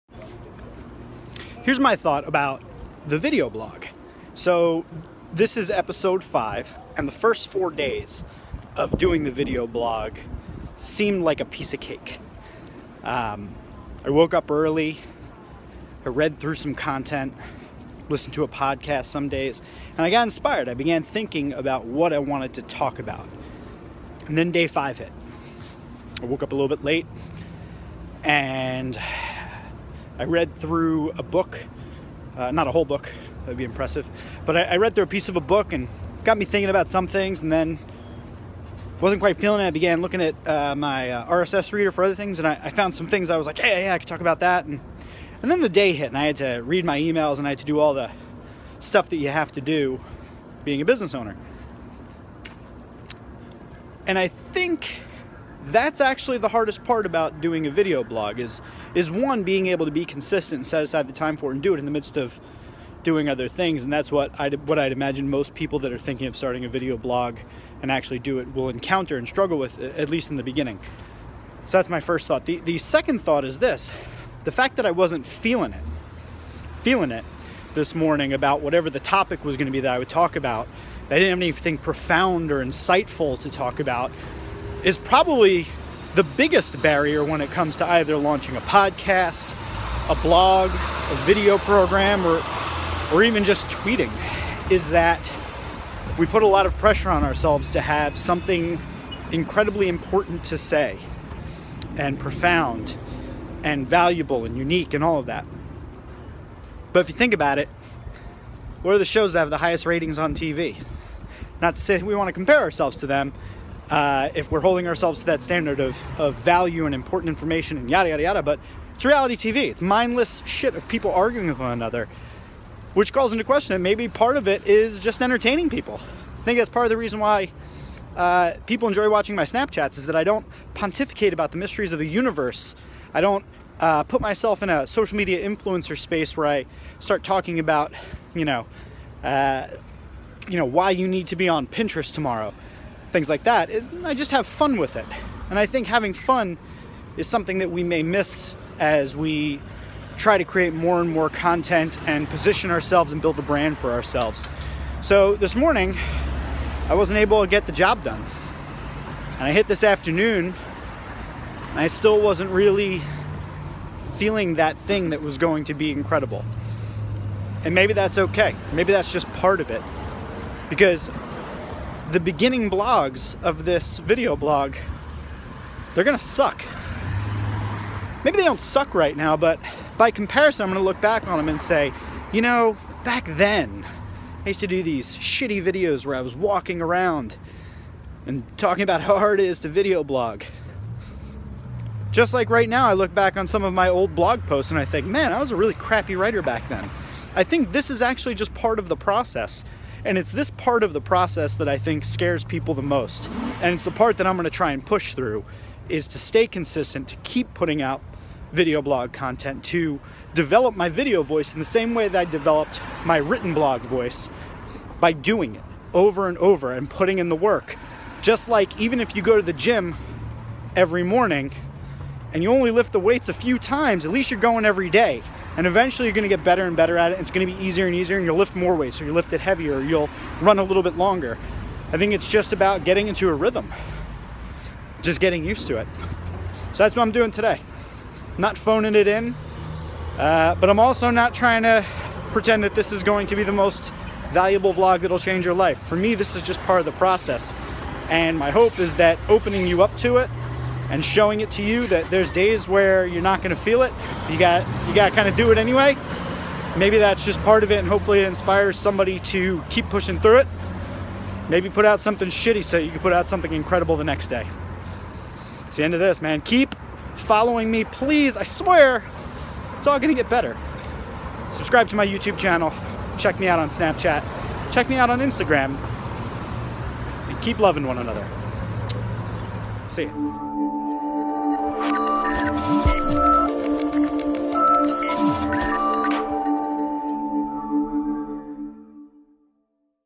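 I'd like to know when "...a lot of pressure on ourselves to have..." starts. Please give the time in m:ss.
1:36.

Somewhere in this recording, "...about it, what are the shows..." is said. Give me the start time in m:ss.
1:47.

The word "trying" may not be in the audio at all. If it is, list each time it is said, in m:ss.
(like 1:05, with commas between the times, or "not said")
4:01.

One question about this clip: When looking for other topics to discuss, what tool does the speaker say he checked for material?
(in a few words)
RSS reader.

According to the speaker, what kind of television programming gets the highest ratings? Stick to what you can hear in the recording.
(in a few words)
Reality TV.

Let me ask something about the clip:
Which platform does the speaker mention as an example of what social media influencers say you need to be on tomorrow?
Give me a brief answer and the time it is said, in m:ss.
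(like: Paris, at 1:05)
Pinterest, at 2:21.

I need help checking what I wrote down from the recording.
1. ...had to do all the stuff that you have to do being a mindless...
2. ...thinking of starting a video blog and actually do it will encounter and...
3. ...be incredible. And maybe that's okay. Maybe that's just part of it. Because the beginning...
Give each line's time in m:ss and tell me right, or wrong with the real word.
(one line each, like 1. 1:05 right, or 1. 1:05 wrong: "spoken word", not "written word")
1. 0:47 wrong: "business", not "mindless"
2. 1:05 right
3. 2:45 right.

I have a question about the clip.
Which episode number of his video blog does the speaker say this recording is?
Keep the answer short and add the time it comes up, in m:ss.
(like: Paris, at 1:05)
5, at 0:05.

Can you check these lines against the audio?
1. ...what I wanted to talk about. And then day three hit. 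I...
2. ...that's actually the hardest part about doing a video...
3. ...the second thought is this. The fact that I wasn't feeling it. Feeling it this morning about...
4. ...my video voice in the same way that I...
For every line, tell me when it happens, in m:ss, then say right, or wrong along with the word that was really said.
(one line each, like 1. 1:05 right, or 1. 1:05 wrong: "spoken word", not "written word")
1. 0:21 wrong: "five", not "three"
2. 0:55 right
3. 1:12 right
4. 3:30 right.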